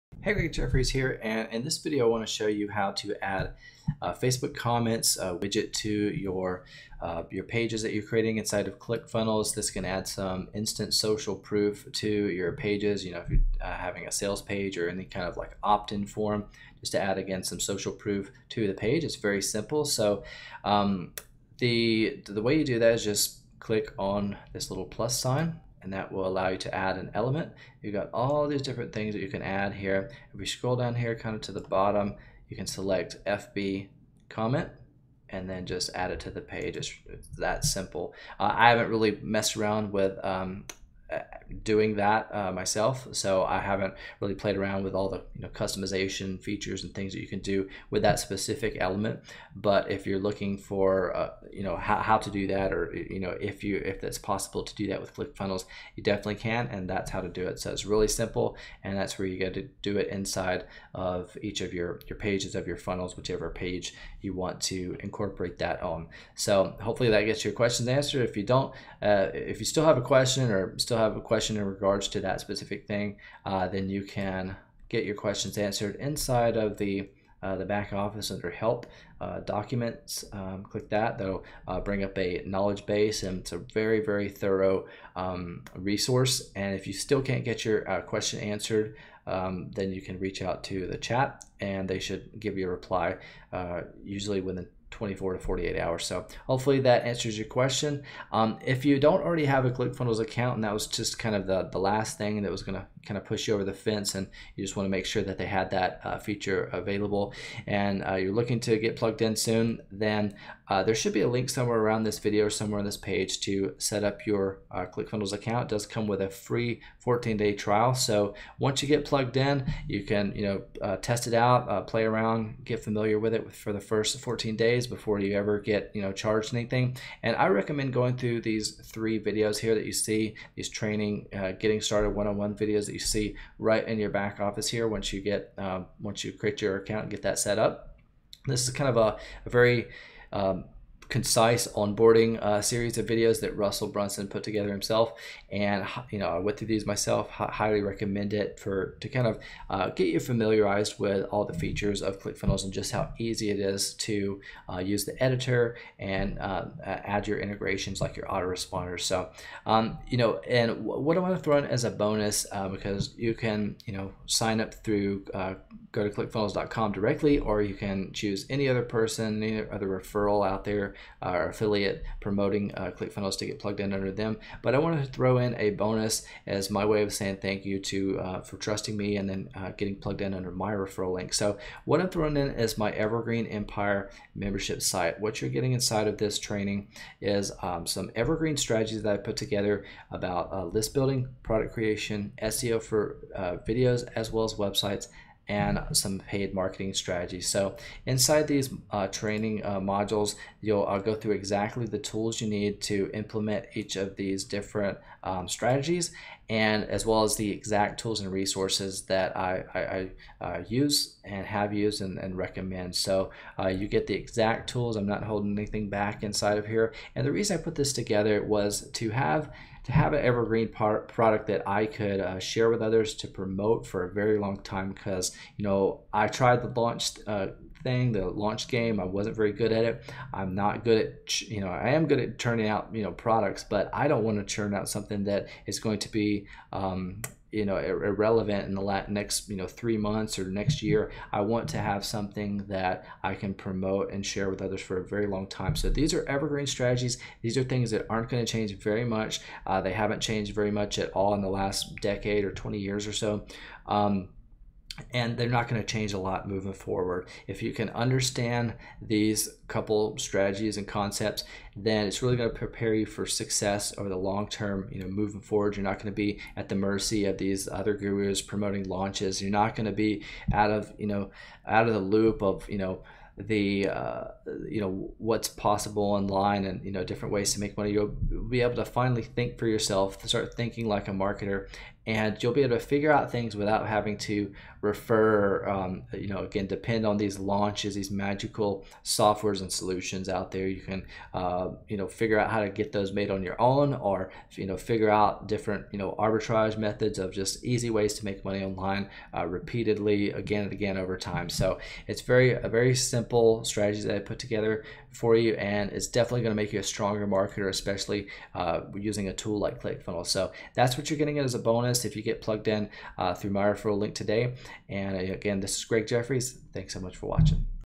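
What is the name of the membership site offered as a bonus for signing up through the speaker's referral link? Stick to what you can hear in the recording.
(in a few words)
Evergreen Empire.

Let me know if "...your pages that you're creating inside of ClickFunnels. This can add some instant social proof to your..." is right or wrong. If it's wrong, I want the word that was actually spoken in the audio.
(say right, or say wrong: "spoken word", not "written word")
right.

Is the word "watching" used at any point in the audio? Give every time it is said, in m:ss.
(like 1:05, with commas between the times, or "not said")
5:17.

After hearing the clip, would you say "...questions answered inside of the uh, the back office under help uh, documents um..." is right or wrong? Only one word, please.
right.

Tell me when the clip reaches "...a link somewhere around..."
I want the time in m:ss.
1:51.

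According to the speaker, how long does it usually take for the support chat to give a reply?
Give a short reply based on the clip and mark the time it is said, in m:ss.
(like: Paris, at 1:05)
24 to 48 hours, at 1:34.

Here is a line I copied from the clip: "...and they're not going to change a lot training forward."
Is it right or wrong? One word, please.
wrong.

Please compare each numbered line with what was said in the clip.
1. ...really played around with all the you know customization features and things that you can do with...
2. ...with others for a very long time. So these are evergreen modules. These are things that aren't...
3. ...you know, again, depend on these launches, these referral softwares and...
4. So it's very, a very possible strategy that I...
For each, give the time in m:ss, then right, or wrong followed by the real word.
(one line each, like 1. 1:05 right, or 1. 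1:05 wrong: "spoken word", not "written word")
1. 0:44 right
2. 4:04 wrong: "strategies", not "modules"
3. 4:46 wrong: "magical", not "referral"
4. 5:01 wrong: "simple", not "possible".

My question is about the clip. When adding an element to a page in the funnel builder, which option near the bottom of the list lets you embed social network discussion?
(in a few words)
FB comment.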